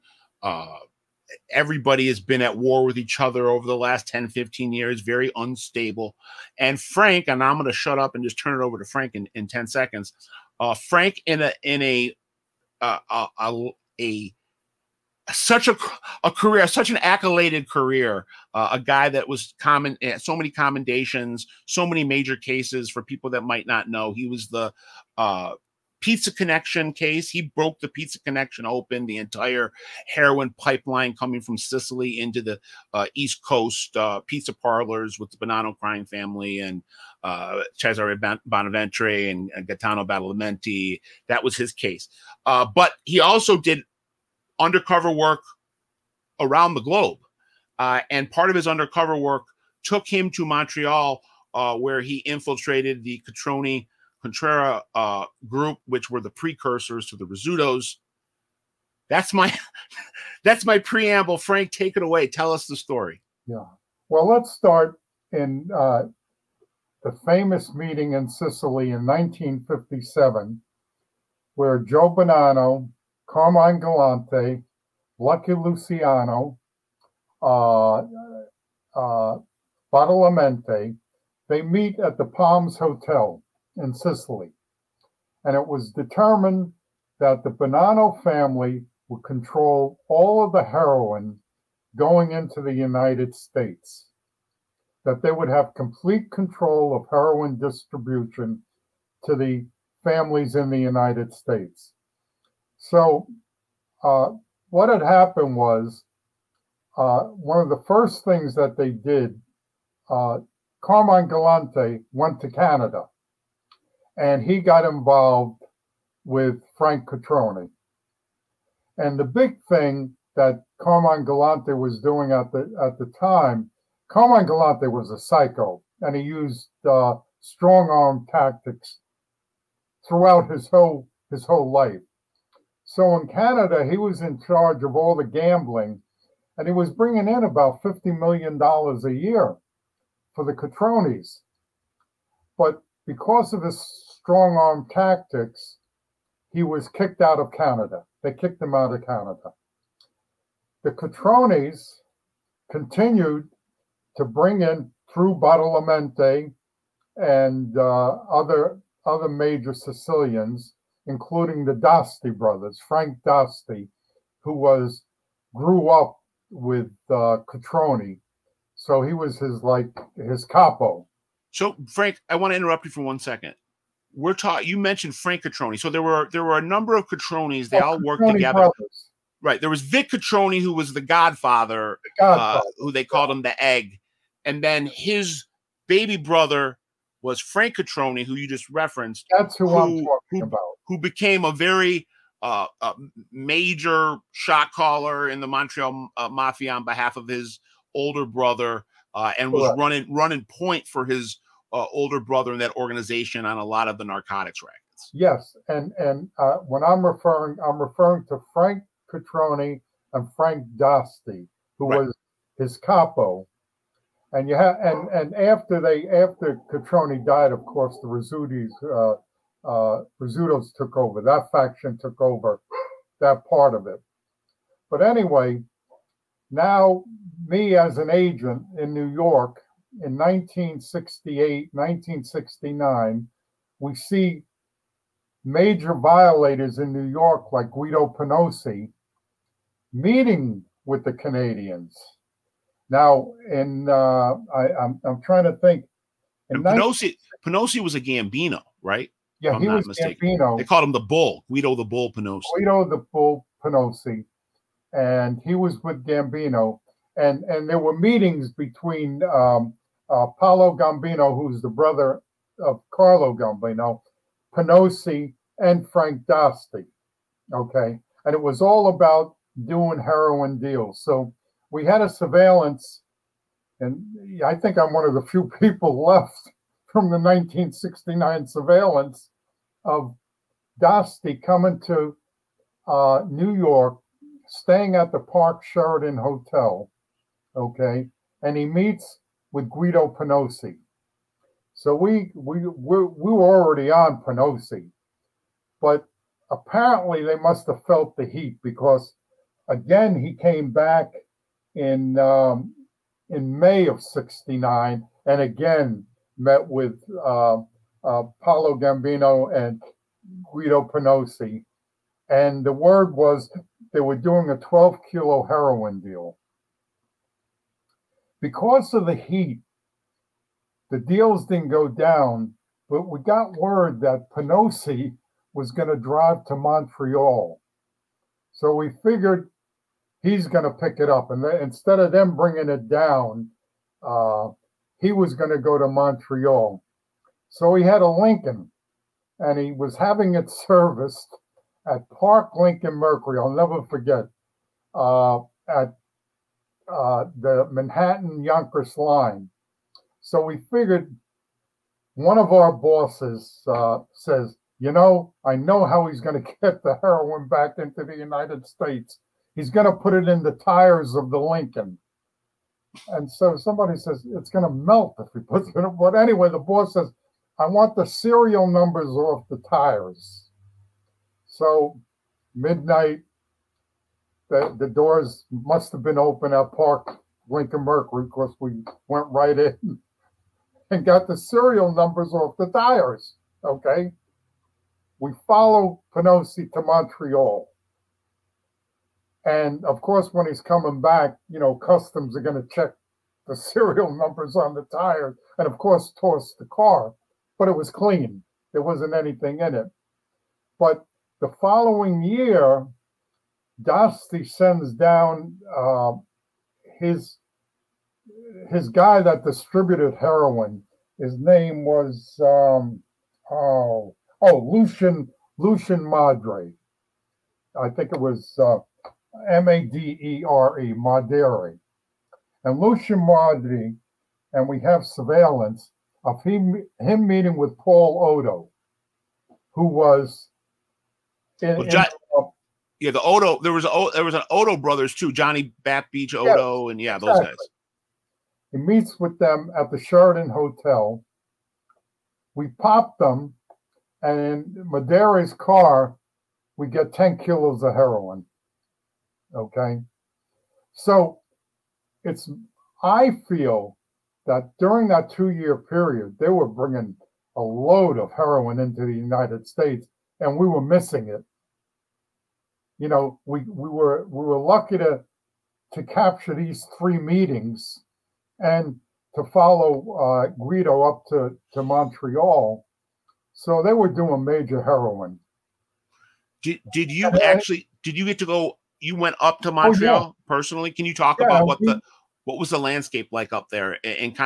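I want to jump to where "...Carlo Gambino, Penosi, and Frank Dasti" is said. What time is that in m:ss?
4:22.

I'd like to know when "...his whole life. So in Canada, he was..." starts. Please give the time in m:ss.
2:11.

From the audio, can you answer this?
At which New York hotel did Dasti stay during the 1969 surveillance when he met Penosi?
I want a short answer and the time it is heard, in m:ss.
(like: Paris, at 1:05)
Park Sheraton Hotel, at 4:45.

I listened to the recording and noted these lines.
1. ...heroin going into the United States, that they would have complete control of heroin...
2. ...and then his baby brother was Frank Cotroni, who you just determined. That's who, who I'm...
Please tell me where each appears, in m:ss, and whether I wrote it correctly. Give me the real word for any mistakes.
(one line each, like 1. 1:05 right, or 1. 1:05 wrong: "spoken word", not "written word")
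1. 1:30 right
2. 3:04 wrong: "referenced", not "determined".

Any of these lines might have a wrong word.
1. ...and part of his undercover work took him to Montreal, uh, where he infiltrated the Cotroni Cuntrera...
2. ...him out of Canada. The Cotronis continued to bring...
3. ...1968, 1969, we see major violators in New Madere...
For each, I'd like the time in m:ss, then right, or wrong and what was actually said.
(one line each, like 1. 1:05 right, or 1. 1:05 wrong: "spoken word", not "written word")
1. 0:48 right
2. 2:28 right
3. 3:50 wrong: "York", not "Madere".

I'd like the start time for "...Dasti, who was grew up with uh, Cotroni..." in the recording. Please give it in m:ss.
2:43.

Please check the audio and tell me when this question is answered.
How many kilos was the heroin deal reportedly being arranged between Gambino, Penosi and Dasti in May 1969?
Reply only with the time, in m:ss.
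5:14.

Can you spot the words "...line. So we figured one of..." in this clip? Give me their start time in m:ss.
5:48.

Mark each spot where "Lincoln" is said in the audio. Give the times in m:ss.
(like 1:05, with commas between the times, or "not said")
5:38, 5:42, 6:01, 6:17.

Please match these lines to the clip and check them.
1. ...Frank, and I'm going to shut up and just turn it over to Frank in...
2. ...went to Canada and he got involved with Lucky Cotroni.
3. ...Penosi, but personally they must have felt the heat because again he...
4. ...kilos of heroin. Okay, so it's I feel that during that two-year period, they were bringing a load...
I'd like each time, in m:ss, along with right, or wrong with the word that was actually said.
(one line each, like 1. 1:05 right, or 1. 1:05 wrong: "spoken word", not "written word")
1. 0:06 right
2. 1:52 wrong: "Frank", not "Lucky"
3. 4:54 wrong: "apparently", not "personally"
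4. 7:27 right.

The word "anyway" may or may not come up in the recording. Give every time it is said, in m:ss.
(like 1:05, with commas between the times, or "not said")
3:45, 6:06.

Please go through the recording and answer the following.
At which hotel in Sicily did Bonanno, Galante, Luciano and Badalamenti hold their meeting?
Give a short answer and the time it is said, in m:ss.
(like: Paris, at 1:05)
Palms Hotel, at 1:22.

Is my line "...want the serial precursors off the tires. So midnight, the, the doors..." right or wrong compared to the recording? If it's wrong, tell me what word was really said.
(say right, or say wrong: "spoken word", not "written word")
wrong: "numbers", not "precursors".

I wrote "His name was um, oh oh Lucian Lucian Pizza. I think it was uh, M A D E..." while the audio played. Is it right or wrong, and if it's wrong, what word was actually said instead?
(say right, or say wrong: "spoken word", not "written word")
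wrong: "Madre", not "Pizza".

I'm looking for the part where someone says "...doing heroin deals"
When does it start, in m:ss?
4:29.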